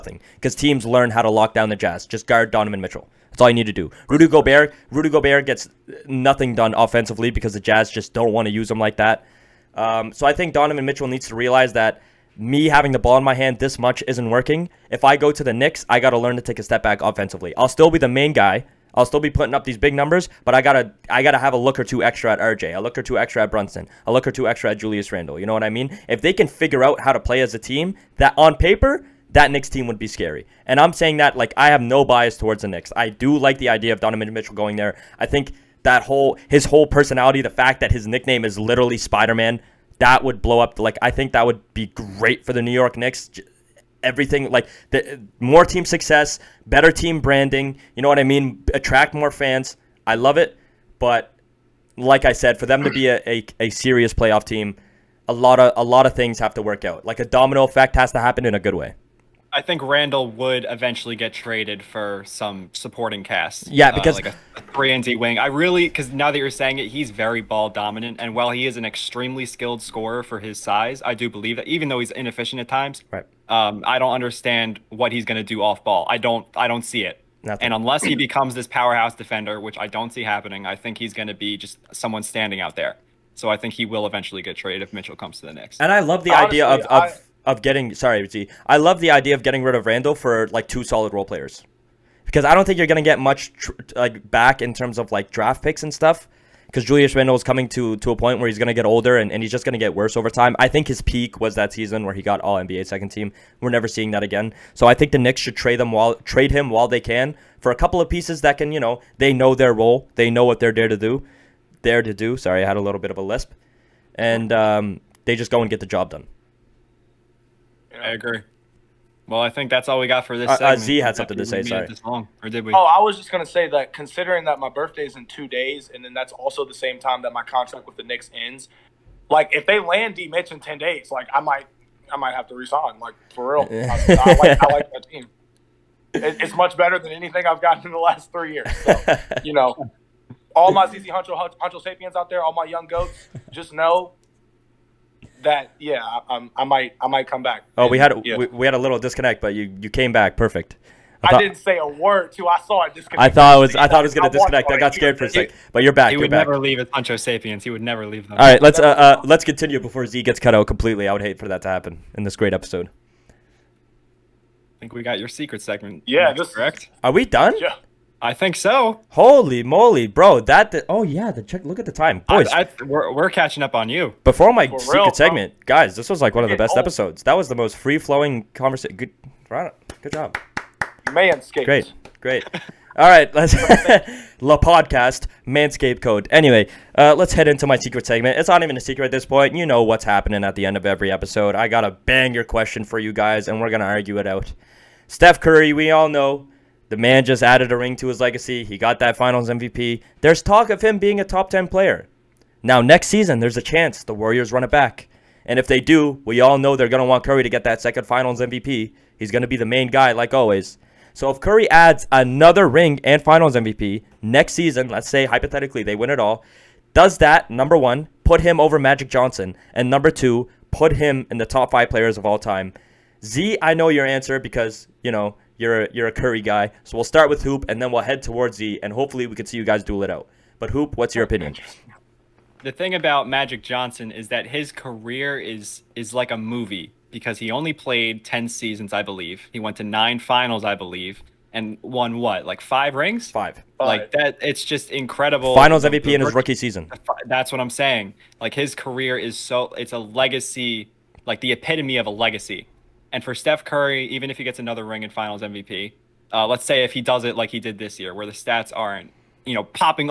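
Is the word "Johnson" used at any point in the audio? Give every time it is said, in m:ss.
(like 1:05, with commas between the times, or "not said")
3:39, 3:53.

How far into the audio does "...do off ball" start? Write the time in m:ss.
1:15.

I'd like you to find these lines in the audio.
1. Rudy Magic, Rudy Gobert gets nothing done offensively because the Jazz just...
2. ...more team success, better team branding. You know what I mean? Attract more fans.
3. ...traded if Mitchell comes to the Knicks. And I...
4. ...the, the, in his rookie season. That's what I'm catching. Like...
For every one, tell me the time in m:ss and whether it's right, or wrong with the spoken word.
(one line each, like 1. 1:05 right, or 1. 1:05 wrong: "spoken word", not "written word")
1. 0:04 wrong: "Gobert", not "Magic"
2. 0:45 right
3. 1:24 right
4. 4:05 wrong: "saying", not "catching".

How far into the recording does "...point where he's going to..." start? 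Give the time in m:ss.
1:38.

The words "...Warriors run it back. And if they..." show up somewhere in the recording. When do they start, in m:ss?
3:24.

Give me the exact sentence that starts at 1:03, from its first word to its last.
Yeah, uh, because uh, like a, a three and D wing.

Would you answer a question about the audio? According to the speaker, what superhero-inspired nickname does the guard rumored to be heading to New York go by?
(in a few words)
Spider Man.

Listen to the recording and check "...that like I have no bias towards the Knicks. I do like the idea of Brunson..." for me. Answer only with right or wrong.
wrong.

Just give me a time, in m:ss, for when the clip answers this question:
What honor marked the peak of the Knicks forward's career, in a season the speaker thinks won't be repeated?
1:42.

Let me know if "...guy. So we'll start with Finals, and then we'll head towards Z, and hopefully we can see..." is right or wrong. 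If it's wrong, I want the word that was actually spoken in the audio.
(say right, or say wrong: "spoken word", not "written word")
wrong: "Hoop", not "Finals".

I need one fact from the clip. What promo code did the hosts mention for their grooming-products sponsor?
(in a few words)
Le Podcast.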